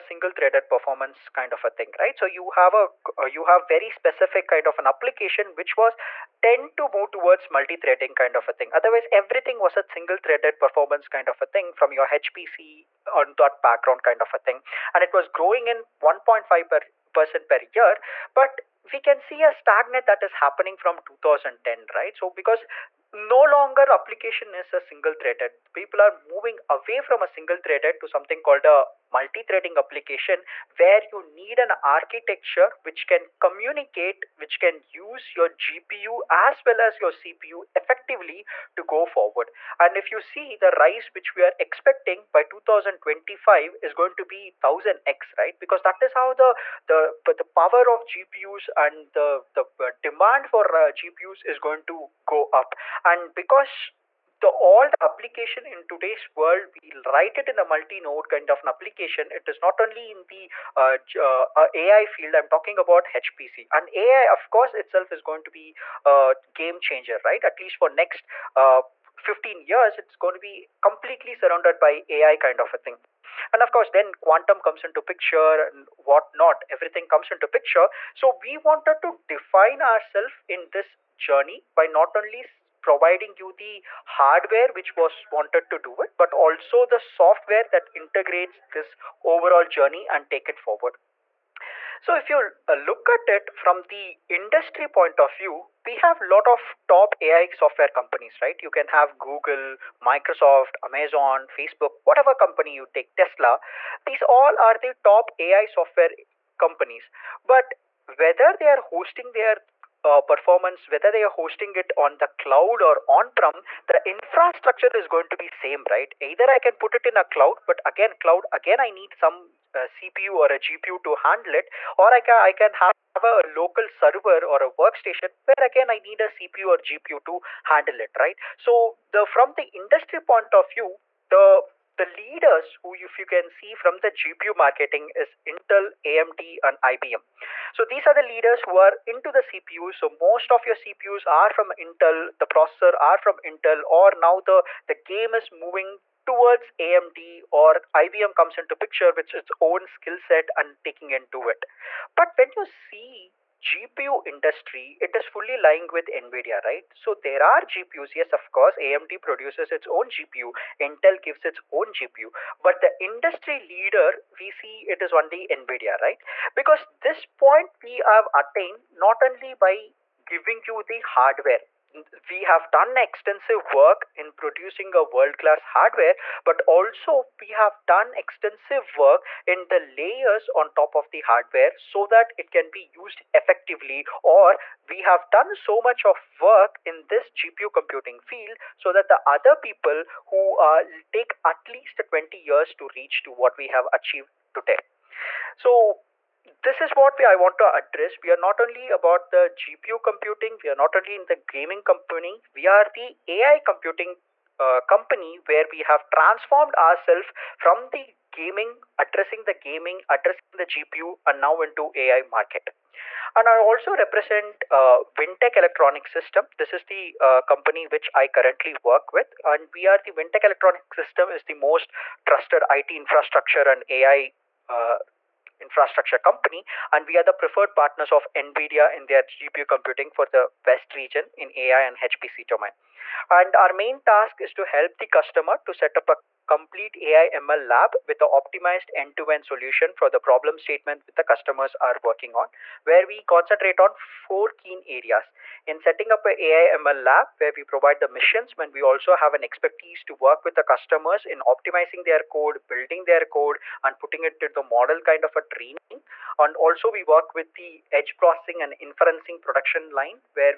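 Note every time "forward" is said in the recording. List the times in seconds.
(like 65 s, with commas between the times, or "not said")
39 s, 90 s.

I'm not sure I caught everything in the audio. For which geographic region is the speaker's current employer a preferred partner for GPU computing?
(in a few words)
West region.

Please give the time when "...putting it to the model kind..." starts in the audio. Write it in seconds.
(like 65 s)
253 s.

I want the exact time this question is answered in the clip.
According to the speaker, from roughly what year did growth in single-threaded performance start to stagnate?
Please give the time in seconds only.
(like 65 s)
21 s.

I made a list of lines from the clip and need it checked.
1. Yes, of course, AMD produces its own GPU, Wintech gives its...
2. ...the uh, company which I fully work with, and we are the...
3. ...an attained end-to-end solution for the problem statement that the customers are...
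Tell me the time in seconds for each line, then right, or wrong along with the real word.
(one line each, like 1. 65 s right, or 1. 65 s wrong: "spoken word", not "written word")
1. 158 s wrong: "Intel", not "Wintech"
2. 216 s wrong: "currently", not "fully"
3. 238 s wrong: "optimized", not "attained".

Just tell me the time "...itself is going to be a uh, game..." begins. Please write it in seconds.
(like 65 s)
64 s.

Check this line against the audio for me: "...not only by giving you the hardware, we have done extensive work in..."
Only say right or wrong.
right.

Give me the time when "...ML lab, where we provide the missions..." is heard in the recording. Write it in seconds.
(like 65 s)
246 s.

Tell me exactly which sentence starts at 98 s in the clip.
You can have Google, Microsoft, Amazon, Facebook, whatever company you take, Tesla.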